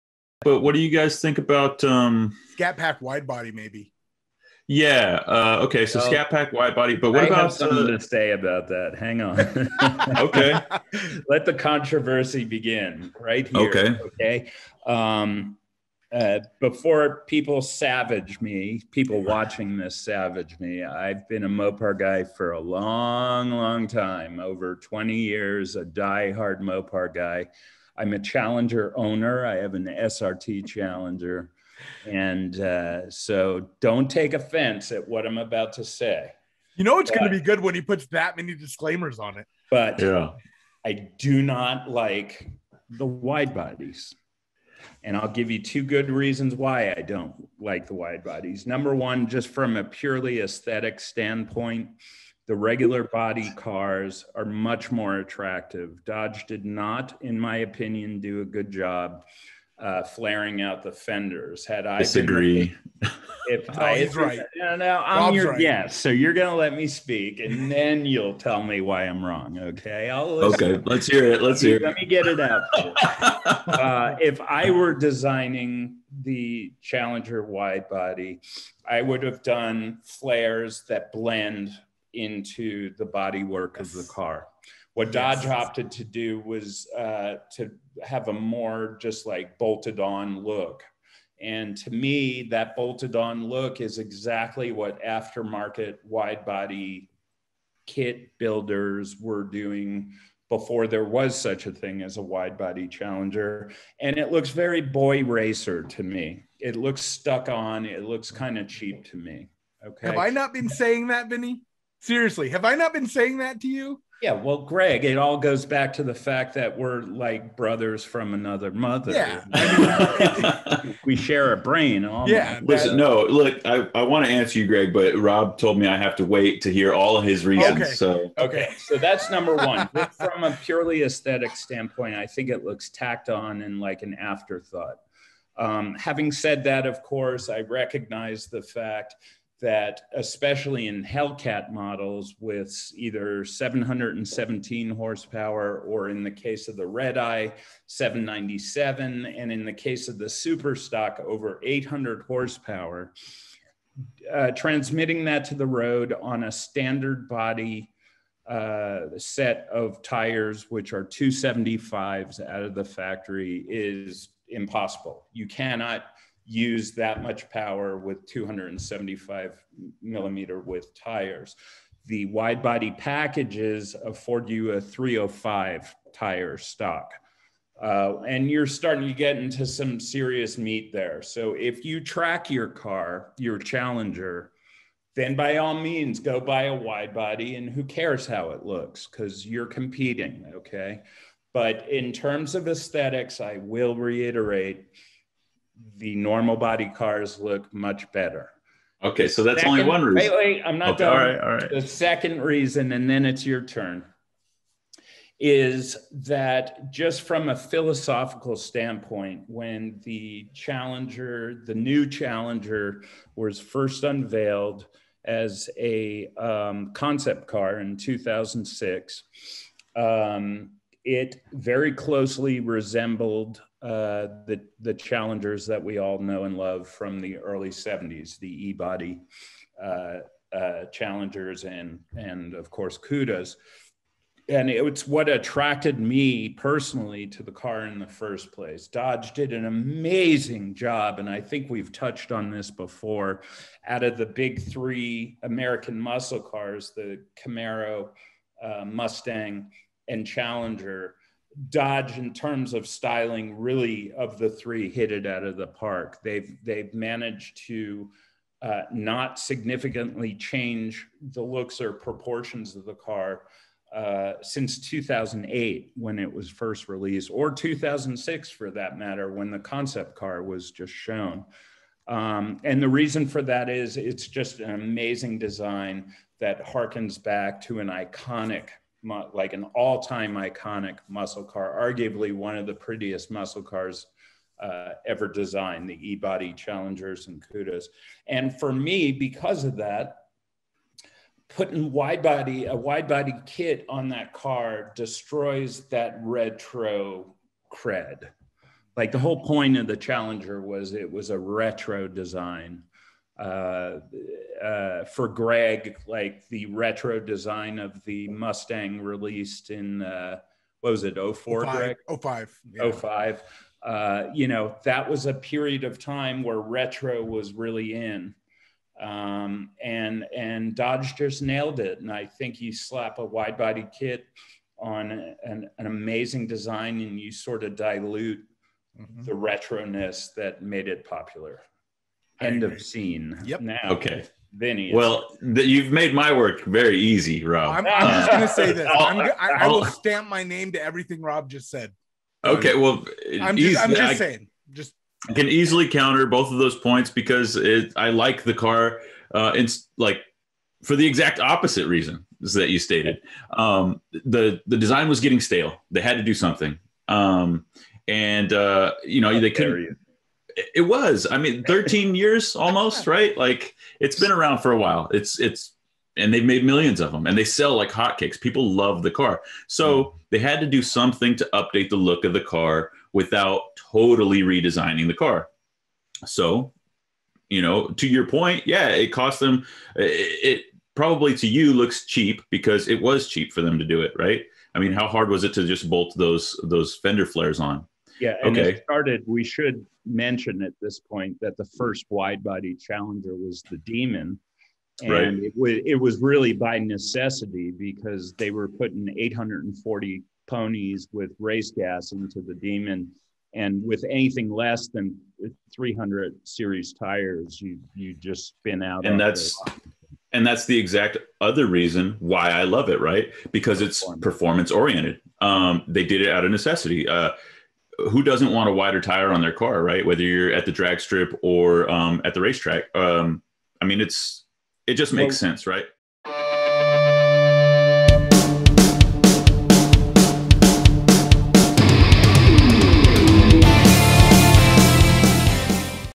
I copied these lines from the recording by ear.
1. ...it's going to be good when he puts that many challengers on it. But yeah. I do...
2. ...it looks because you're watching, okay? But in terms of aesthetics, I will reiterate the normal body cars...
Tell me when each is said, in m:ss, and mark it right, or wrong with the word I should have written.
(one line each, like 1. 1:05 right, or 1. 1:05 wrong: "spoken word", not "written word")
1. 0:36 wrong: "disclaimers", not "challengers"
2. 3:08 wrong: "competing", not "watching".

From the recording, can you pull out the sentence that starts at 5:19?
Um, and, and Dodge just nailed it.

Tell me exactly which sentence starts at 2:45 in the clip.
You cannot use that much power with 275 millimeter width tires.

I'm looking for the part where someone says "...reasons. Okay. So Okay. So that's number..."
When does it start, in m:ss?
2:07.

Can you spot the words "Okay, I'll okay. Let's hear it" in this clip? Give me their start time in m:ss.
1:09.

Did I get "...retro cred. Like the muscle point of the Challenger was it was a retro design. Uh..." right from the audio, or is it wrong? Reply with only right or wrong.
wrong.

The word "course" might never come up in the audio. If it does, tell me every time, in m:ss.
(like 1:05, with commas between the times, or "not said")
2:17, 3:52.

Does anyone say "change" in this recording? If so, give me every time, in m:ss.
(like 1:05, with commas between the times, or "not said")
4:20.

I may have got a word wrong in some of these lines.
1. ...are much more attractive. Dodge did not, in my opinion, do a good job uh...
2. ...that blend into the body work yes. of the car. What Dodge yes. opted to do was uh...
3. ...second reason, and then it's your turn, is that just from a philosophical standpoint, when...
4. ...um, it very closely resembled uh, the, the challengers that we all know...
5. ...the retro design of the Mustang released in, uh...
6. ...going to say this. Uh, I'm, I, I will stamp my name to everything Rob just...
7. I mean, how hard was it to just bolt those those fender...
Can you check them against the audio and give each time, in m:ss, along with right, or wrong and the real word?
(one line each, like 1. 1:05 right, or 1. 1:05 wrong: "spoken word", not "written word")
1. 0:54 right
2. 1:20 right
3. 3:21 right
4. 3:39 right
5. 5:06 right
6. 5:38 right
7. 6:24 right.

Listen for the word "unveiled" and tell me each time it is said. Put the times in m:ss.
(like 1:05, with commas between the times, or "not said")
3:34.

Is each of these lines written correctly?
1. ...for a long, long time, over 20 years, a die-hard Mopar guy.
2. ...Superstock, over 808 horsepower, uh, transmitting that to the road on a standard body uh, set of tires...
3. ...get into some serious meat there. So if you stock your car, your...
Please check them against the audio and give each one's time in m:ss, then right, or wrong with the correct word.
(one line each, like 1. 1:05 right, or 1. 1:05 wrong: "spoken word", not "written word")
1. 0:22 right
2. 2:30 wrong: "800", not "808"
3. 2:59 wrong: "track", not "stock".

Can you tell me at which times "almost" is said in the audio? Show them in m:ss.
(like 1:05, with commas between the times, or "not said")
2:02, 6:02.